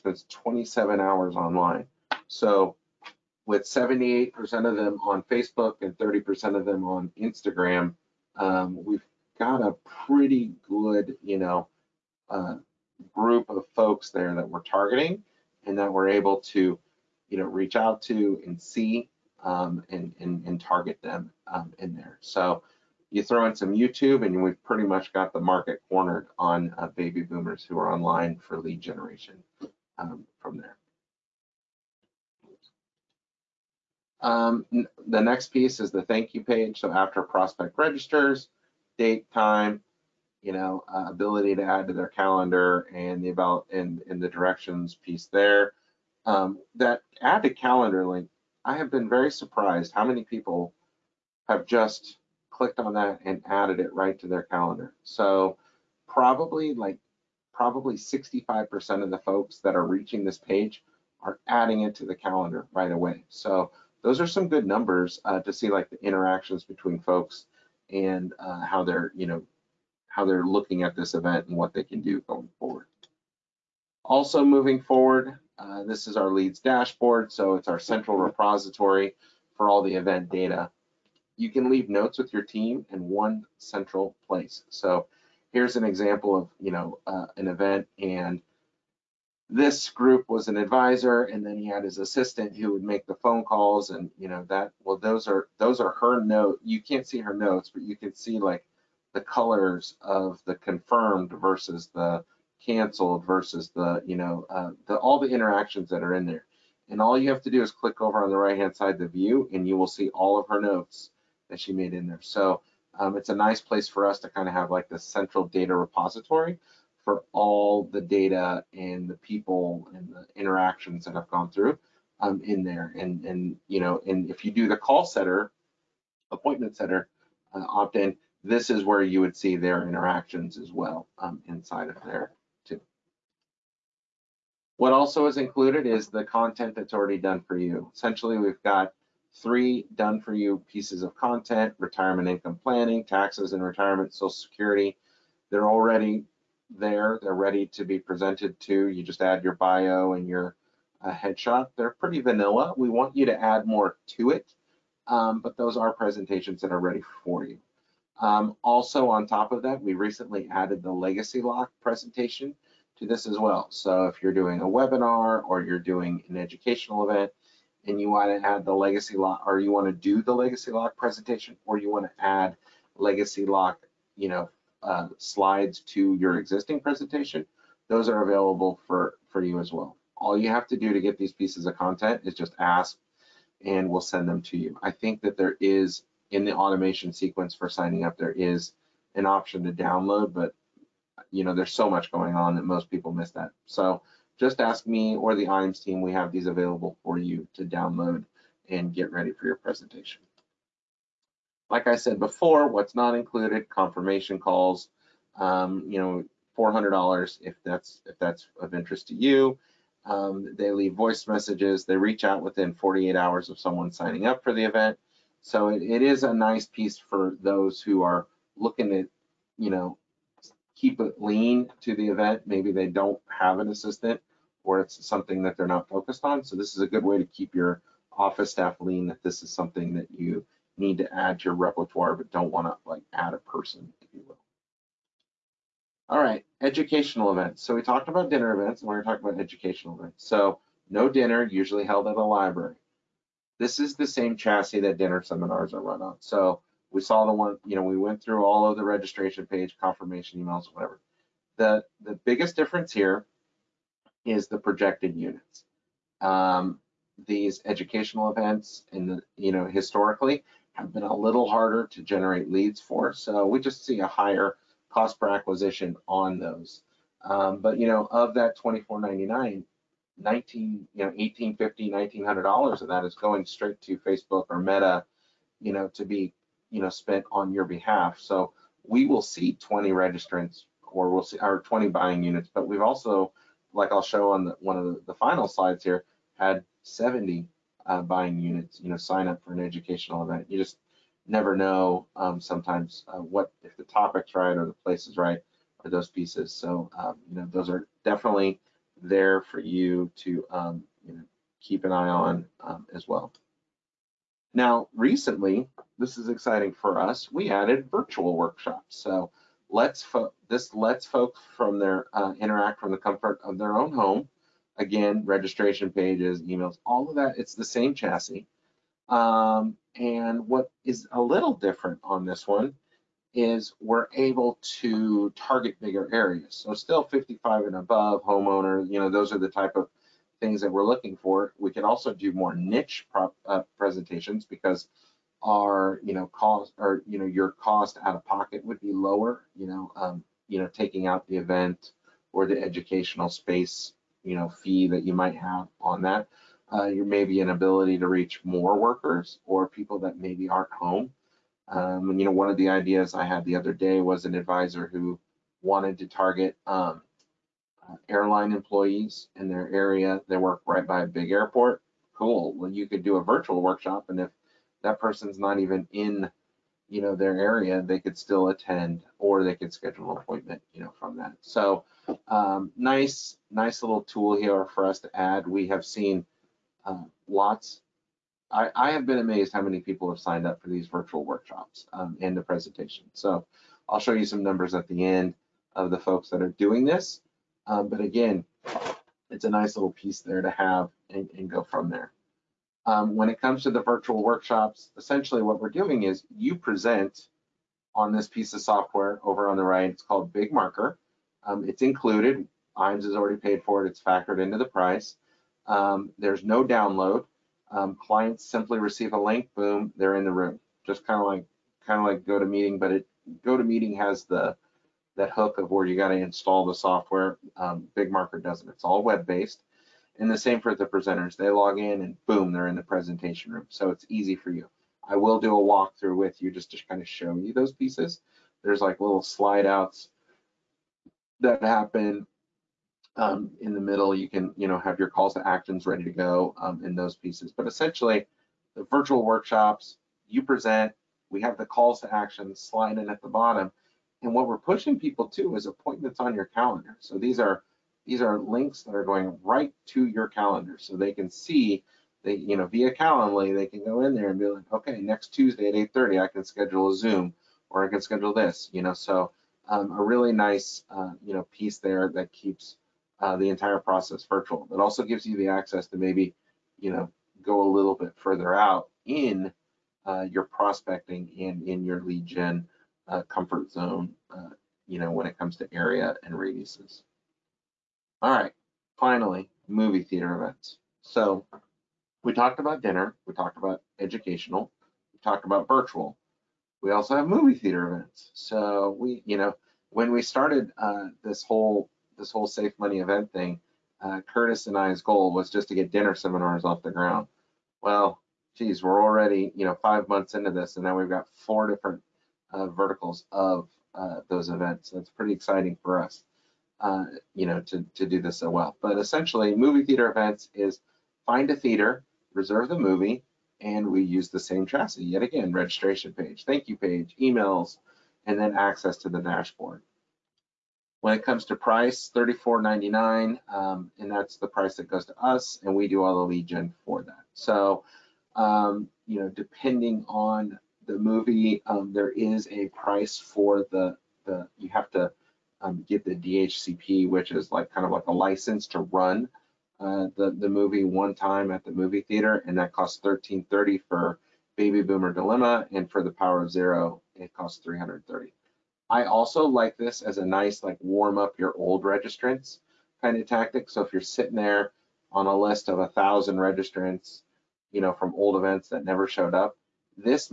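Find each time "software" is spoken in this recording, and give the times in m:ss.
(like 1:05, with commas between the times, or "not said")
6:38, 6:56.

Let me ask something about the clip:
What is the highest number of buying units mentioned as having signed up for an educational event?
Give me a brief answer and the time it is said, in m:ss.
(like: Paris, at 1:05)
70, at 4:46.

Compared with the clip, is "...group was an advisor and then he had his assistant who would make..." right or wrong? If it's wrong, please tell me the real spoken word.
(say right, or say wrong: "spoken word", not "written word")
right.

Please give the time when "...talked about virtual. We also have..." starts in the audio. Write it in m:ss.
8:05.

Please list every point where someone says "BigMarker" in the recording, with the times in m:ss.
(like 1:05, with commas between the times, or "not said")
6:40, 6:57.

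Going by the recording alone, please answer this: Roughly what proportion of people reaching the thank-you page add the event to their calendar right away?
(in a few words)
65%.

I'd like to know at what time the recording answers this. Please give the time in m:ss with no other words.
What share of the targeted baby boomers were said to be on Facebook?
0:03.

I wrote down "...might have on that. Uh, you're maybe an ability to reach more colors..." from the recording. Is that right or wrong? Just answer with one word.
wrong.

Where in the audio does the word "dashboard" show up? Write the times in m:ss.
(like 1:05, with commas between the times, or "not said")
1:16, 8:39.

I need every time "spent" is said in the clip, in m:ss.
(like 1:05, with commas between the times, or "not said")
4:36.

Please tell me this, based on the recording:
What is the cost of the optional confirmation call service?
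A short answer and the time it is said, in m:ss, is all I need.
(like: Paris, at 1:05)
$400, at 3:26.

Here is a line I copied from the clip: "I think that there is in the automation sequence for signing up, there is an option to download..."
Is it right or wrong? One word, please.
right.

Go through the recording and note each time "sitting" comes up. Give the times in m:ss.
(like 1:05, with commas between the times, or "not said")
9:14.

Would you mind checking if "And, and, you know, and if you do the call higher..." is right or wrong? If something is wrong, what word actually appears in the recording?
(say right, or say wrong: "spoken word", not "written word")
wrong: "center", not "higher".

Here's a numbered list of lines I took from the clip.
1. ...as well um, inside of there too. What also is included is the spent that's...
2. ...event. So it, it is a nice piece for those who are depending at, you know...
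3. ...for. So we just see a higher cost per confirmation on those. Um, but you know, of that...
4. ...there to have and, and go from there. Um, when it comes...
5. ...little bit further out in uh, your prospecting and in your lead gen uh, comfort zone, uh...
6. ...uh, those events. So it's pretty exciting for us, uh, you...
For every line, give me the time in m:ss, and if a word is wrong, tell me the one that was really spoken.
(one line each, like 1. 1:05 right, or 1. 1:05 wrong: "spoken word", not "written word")
1. 2:10 wrong: "content", not "spent"
2. 3:34 wrong: "looking", not "depending"
3. 4:22 wrong: "acquisition", not "confirmation"
4. 6:30 right
5. 7:47 right
6. 8:23 right.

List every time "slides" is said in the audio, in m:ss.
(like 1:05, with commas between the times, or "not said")
2:55, 4:45, 7:09, 7:22.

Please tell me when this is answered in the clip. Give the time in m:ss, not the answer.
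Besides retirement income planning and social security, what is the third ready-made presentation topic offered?
2:23.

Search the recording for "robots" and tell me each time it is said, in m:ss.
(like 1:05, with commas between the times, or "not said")
not said.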